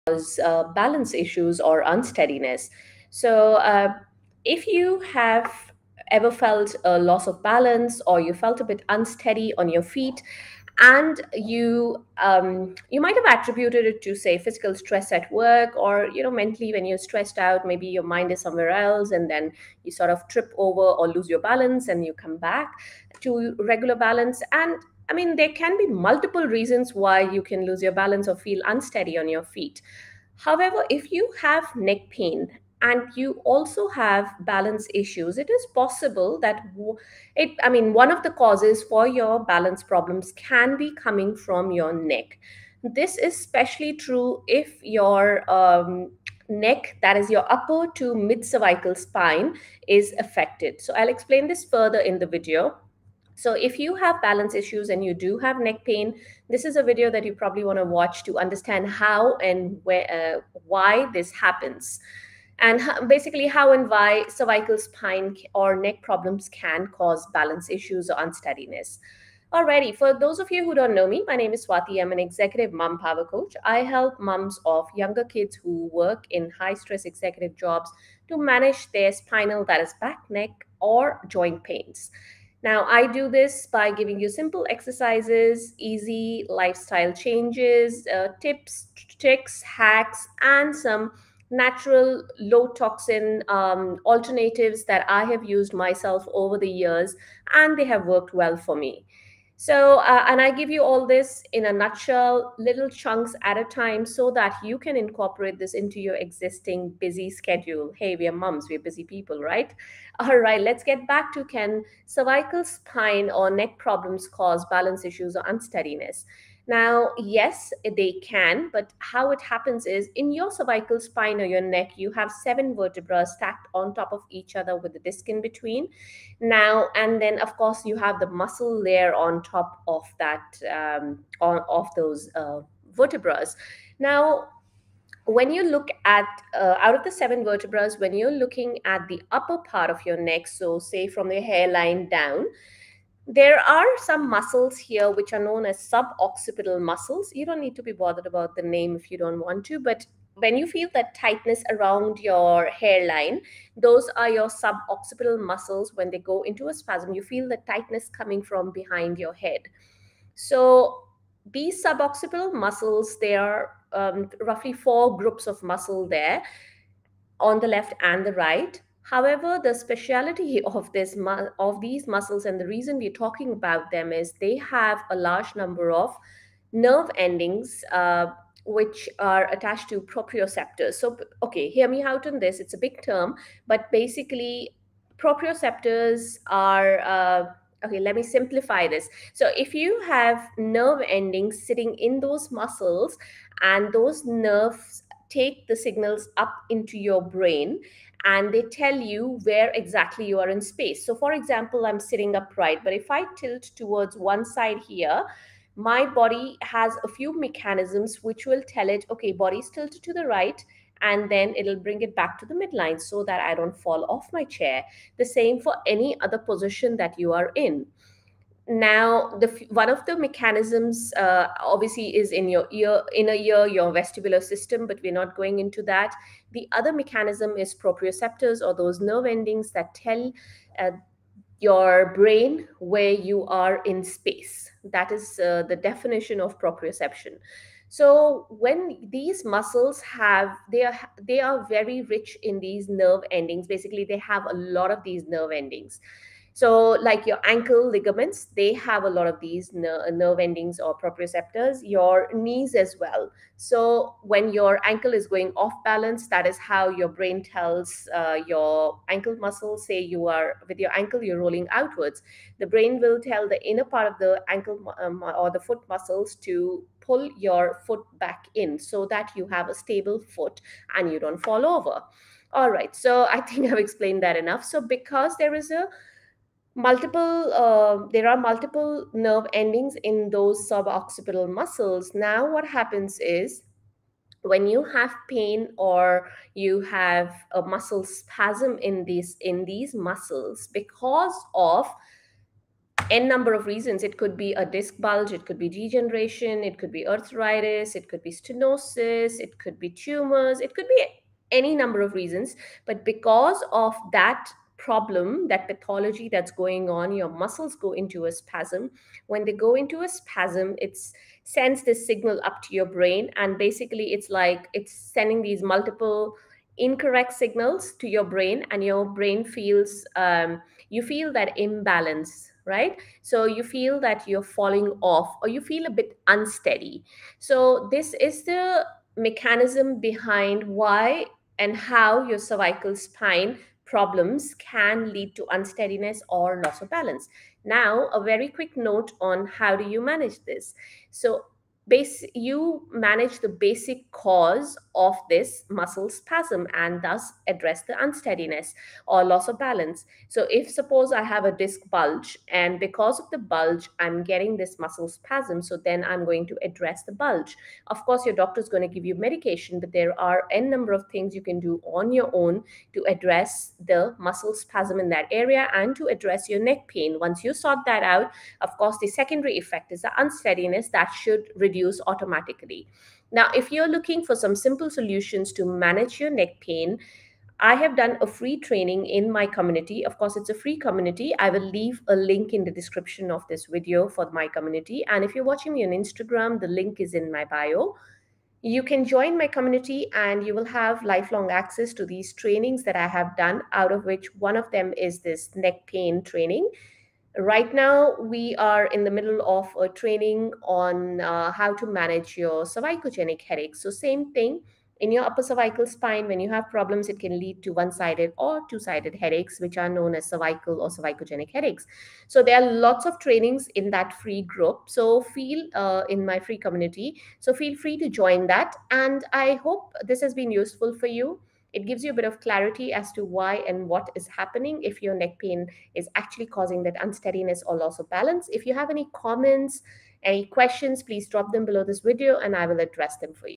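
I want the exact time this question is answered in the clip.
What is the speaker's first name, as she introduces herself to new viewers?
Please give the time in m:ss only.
1:11.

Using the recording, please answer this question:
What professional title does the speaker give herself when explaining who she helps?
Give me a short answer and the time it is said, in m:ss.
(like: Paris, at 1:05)
executive mom power coach, at 1:12.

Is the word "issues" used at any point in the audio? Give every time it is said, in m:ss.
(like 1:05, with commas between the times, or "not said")
0:01, 0:34, 0:54, 1:07, 1:55.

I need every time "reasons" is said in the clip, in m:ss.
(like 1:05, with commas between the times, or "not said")
0:26, 2:52, 4:53, 5:02.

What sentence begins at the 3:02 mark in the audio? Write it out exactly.
It's a big term, but basically, proprioceptors are.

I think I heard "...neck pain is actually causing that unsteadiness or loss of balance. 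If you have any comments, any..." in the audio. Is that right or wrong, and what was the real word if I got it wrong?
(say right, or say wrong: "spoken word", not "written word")
right.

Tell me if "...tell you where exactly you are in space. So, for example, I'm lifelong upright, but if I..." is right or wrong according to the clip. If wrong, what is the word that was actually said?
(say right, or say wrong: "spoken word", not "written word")
wrong: "sitting", not "lifelong".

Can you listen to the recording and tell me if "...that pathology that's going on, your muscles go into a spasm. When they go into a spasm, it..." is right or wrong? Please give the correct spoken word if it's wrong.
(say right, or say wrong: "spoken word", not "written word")
right.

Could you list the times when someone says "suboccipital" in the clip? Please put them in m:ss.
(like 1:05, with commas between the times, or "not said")
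2:25, 2:34, 2:41, 4:40.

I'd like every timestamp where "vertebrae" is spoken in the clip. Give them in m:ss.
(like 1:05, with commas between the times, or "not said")
2:02, 2:12, 2:17.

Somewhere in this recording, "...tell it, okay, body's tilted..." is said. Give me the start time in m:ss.
3:28.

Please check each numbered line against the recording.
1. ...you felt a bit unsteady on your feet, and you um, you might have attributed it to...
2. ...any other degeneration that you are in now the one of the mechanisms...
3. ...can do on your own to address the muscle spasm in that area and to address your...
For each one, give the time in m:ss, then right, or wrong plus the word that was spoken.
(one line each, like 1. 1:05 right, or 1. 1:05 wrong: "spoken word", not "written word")
1. 0:08 right
2. 3:35 wrong: "position", not "degeneration"
3. 6:01 right.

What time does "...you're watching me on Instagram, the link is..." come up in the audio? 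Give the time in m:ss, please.
6:25.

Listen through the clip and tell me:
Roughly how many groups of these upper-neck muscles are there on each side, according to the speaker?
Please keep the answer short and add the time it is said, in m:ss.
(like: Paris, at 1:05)
4, at 2:44.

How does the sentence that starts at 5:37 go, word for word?
Now, a very quick note on how do you manage this.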